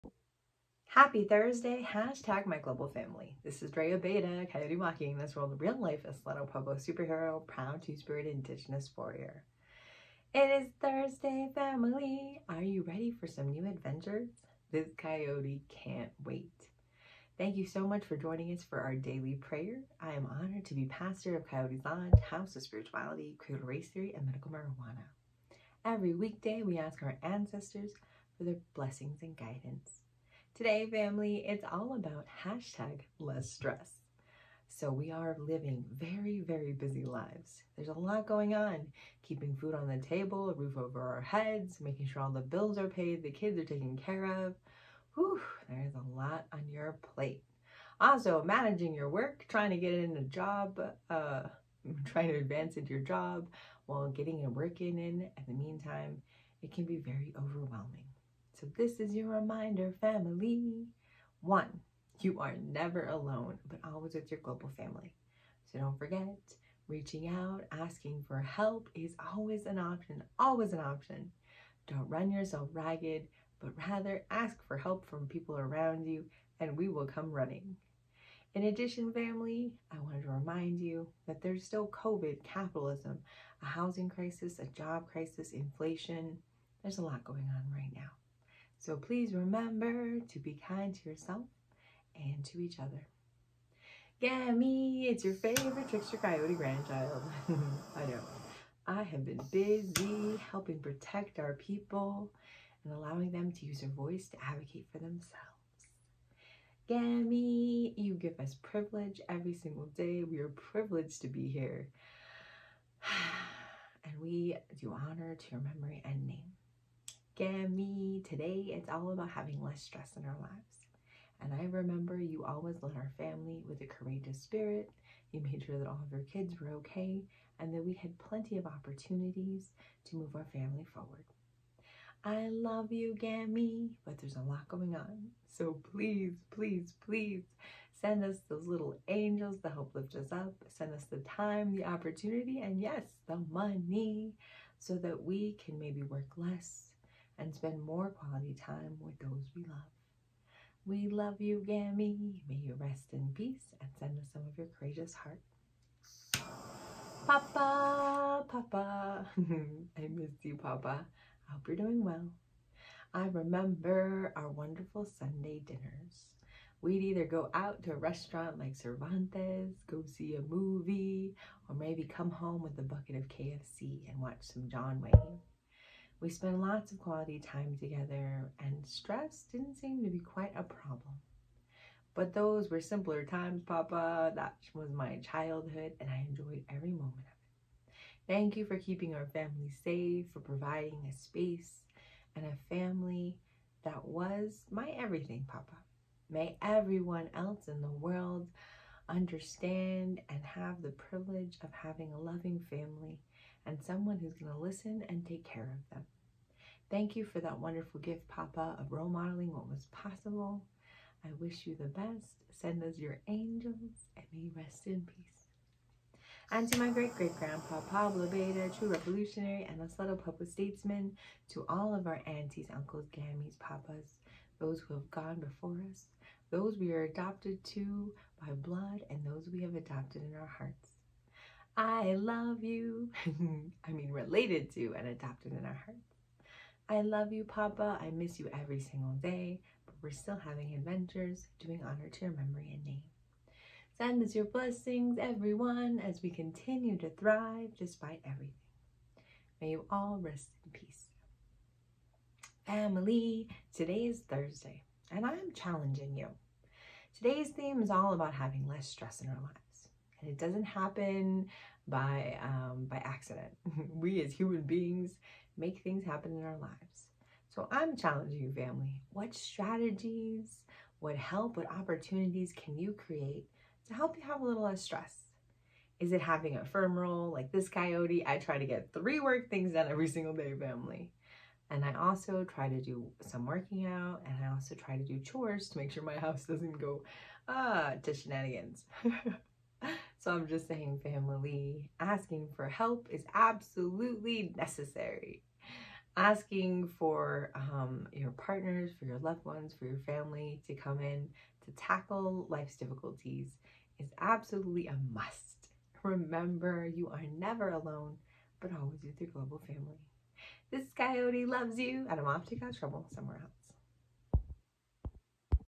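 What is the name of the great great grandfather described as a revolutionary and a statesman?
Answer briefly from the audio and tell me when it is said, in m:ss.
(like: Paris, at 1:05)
Pablo Abeita, at 3:37.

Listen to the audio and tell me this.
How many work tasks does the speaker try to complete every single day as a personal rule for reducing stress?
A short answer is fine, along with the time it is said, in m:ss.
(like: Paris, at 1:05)
3, at 4:38.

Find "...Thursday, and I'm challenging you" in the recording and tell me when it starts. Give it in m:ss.
4:14.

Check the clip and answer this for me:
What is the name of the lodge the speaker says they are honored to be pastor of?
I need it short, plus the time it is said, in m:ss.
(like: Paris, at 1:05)
Coyote Lodge, at 0:21.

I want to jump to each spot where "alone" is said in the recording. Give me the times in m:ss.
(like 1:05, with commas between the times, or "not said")
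1:03, 5:07.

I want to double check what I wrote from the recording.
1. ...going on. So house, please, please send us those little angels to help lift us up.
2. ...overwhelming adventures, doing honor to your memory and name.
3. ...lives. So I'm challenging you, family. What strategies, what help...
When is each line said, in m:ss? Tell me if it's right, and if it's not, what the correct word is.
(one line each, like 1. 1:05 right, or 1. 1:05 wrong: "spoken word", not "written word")
1. 2:14 wrong: "please", not "house"
2. 4:00 wrong: "having", not "overwhelming"
3. 4:26 right.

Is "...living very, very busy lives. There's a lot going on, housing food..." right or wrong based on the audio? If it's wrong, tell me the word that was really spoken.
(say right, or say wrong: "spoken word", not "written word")
wrong: "keeping", not "housing".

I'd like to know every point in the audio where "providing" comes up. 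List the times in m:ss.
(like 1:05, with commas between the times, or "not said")
3:10.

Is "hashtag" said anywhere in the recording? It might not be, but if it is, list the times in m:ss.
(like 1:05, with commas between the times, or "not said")
0:01, 0:32.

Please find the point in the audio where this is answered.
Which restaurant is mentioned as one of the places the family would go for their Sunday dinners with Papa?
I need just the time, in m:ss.
2:48.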